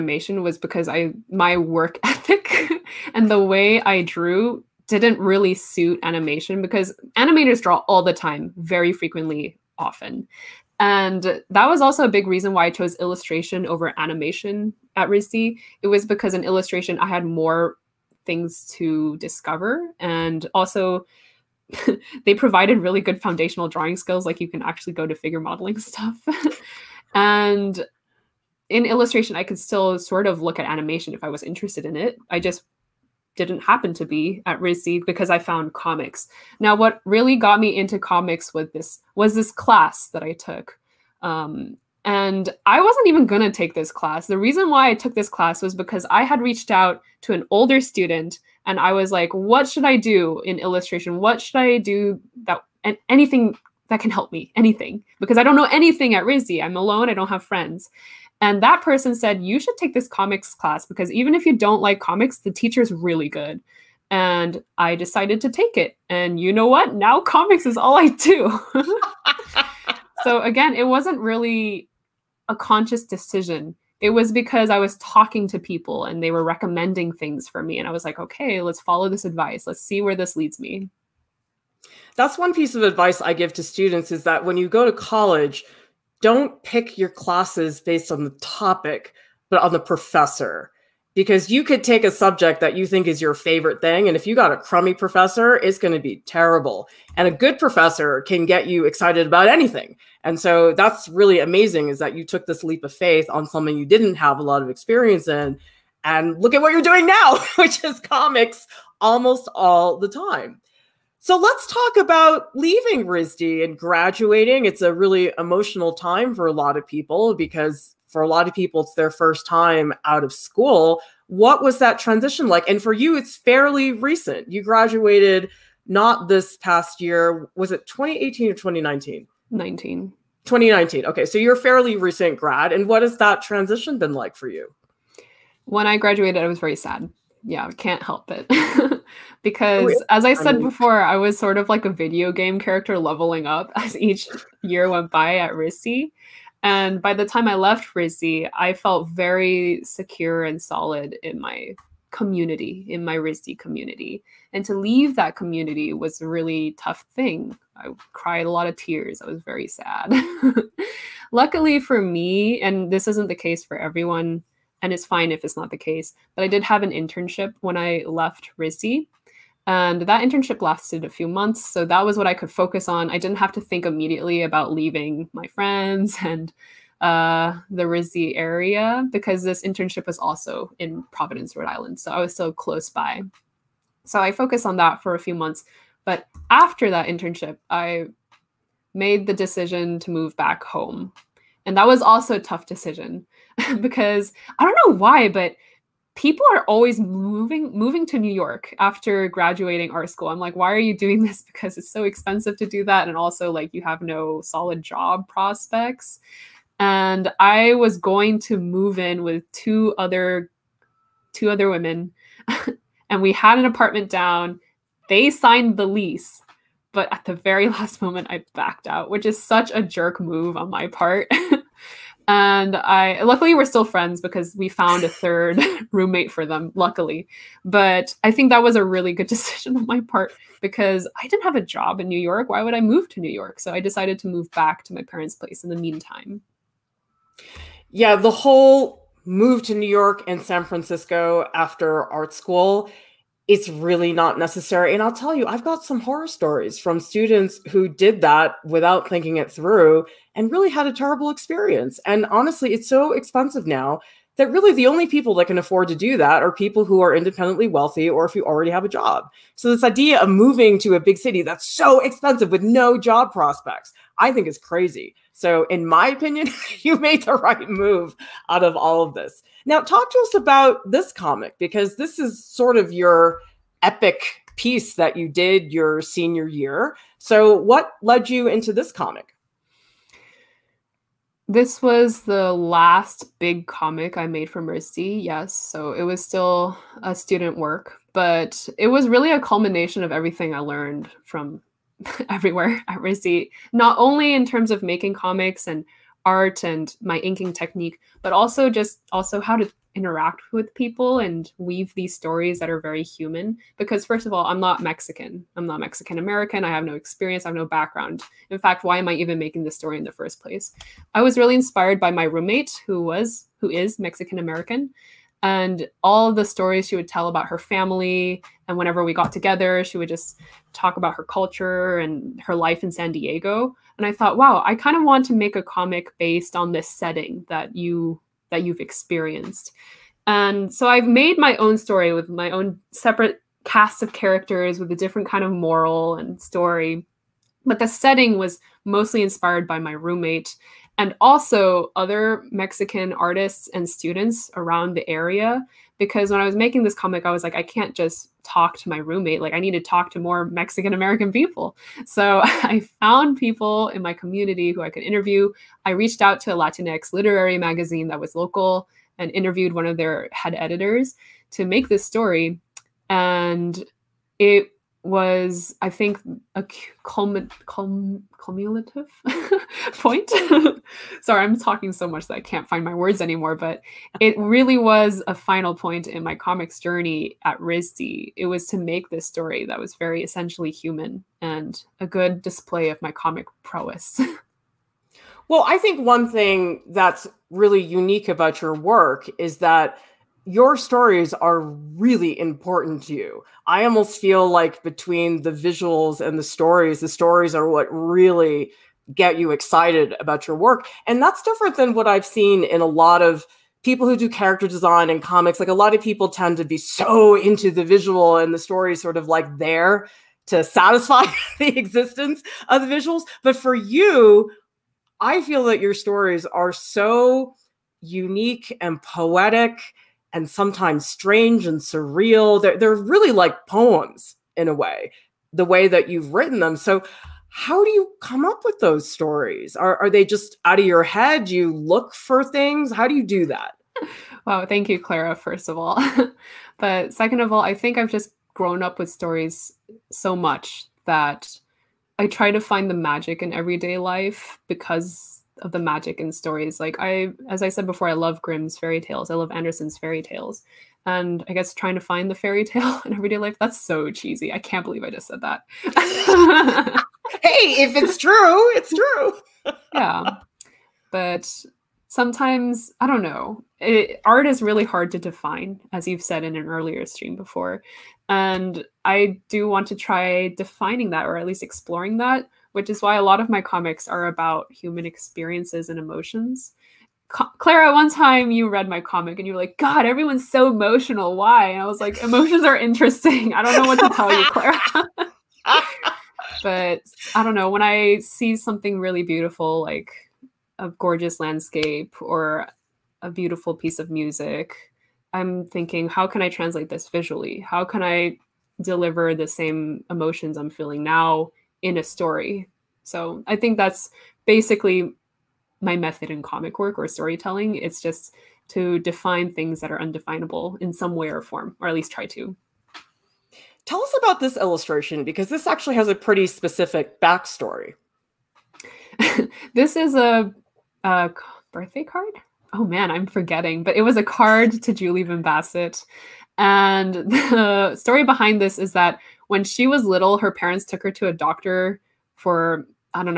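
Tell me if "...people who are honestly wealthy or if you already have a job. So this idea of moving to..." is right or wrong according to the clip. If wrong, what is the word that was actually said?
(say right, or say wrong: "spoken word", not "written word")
wrong: "independently", not "honestly".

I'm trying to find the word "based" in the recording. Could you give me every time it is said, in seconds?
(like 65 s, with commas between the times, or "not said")
87 s, 326 s.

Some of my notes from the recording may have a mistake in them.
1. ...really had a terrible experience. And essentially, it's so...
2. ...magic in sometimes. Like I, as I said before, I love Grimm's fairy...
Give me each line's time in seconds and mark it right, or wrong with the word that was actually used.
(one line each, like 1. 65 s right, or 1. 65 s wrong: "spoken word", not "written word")
1. 250 s wrong: "honestly", not "essentially"
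2. 445 s wrong: "stories", not "sometimes".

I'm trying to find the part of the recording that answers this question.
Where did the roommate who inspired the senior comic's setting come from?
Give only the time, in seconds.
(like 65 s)
322 s.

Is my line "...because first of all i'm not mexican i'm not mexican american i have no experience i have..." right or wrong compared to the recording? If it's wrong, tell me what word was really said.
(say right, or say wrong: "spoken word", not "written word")
right.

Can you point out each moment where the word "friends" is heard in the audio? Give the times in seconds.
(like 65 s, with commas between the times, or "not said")
57 s, 175 s, 223 s.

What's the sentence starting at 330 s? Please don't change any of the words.
And so I've made my own story with my own separate casts of characters with a different kind of moral and story.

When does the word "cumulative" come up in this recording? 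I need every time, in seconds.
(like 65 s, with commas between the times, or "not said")
368 s.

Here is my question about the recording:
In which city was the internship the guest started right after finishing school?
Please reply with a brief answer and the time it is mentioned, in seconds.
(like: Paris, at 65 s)
Providence, at 181 s.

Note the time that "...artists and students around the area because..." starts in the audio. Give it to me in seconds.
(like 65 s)
343 s.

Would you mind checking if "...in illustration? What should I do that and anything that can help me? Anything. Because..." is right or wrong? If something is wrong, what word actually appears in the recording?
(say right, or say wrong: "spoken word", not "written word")
right.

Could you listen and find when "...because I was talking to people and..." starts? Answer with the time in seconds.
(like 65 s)
74 s.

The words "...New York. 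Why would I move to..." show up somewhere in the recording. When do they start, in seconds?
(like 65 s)
232 s.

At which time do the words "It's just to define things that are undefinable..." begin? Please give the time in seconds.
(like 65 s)
507 s.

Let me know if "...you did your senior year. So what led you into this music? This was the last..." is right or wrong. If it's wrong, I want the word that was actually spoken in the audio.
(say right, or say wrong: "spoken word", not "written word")
wrong: "comic", not "music".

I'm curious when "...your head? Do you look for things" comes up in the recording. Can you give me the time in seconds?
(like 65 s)
430 s.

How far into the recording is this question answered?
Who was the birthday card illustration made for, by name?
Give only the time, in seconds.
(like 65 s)
524 s.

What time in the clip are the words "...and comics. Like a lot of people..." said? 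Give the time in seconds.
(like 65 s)
405 s.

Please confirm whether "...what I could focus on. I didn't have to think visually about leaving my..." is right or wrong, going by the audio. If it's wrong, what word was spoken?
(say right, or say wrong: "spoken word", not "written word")
wrong: "immediately", not "visually".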